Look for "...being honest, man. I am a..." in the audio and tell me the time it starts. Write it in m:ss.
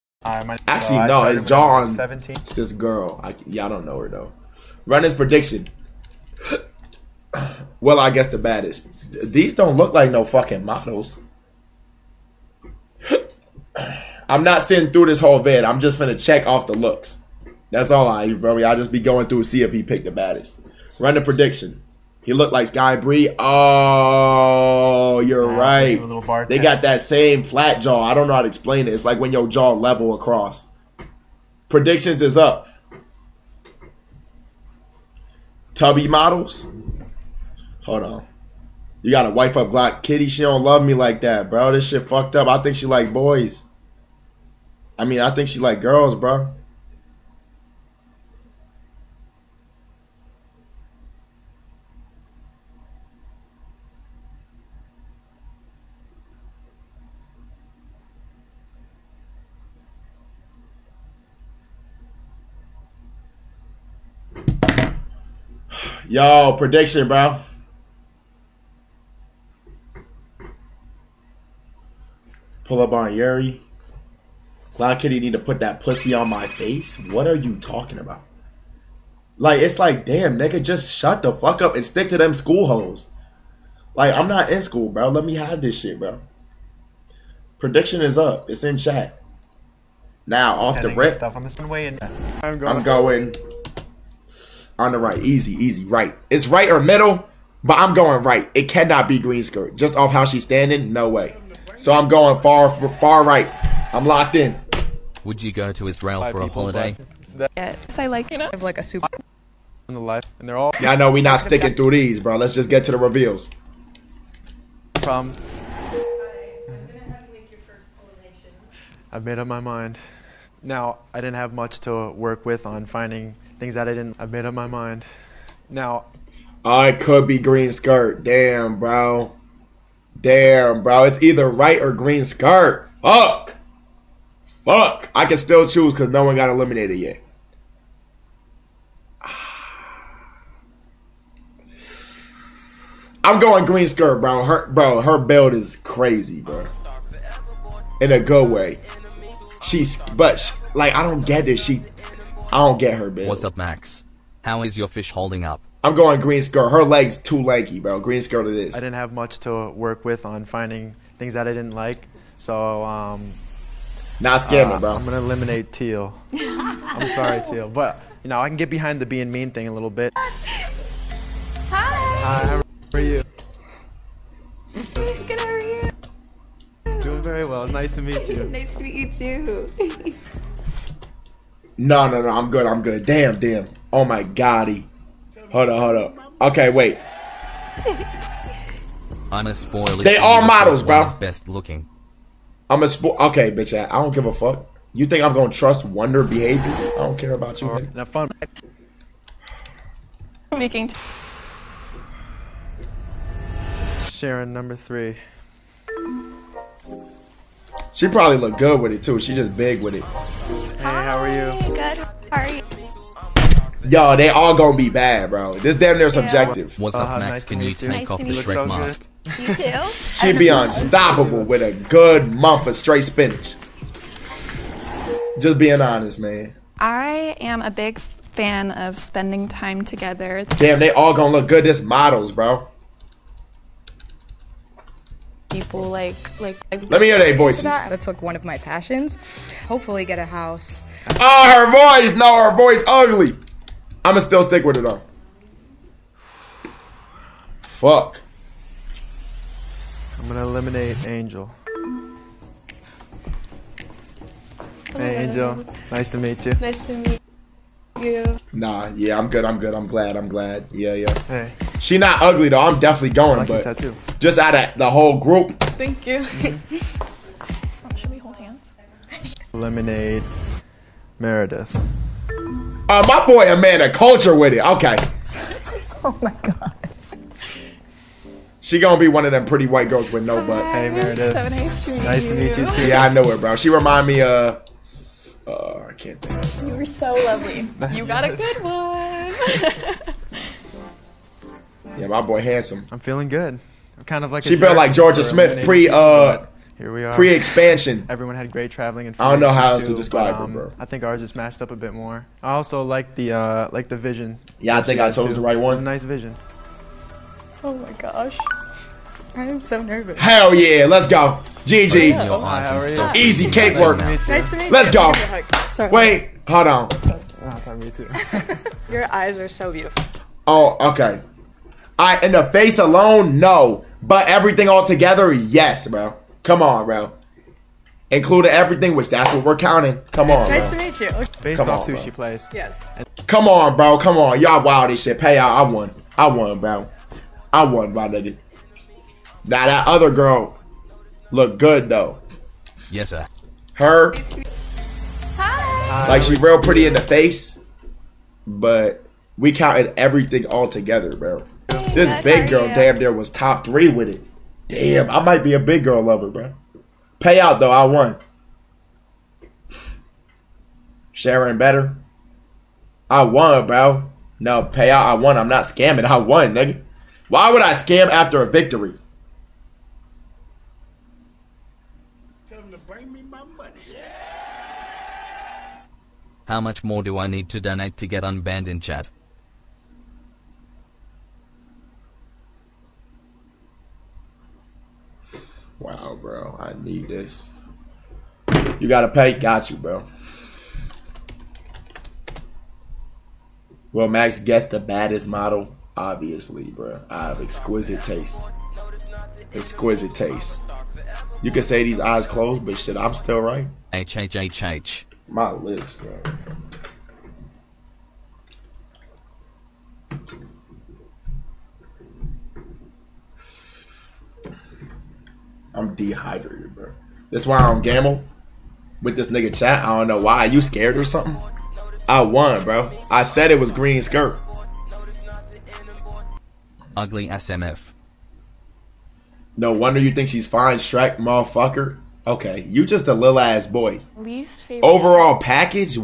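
3:45.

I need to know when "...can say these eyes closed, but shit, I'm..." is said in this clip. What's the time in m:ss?
6:41.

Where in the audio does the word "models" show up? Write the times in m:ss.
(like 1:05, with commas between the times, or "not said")
0:10, 0:36, 3:10, 3:51, 6:35.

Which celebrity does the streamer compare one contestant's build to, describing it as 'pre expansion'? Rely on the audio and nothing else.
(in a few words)
Georgia Smith.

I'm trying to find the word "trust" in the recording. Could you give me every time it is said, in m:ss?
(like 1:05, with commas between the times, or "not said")
3:15.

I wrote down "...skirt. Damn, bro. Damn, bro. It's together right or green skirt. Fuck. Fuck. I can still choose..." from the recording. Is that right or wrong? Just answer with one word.
wrong.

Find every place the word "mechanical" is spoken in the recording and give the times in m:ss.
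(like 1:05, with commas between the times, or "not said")
not said.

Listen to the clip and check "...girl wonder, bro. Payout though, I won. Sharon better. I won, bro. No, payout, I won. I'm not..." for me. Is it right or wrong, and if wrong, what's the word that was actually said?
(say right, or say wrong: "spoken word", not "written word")
wrong: "lover", not "wonder".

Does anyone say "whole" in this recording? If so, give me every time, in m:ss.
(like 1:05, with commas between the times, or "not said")
0:15, 4:24.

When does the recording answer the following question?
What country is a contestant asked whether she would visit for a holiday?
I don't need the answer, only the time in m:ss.
1:45.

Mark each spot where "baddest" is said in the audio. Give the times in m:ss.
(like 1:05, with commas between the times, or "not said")
0:08, 0:20, 6:34.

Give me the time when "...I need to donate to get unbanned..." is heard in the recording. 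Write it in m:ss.
6:17.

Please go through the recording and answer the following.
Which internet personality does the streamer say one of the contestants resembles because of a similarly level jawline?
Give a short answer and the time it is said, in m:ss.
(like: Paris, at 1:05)
Sky Bri, at 0:22.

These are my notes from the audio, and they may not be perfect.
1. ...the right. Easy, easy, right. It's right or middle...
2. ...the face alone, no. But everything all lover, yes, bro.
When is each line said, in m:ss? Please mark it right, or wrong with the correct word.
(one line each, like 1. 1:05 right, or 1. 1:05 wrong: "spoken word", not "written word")
1. 1:34 right
2. 5:22 wrong: "together", not "lover".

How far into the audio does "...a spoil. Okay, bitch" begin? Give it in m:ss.
3:12.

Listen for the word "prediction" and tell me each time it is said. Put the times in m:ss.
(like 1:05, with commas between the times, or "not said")
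0:05, 0:21, 0:31, 1:06, 1:27.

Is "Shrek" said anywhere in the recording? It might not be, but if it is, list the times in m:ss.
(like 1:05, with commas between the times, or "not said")
3:38, 7:10.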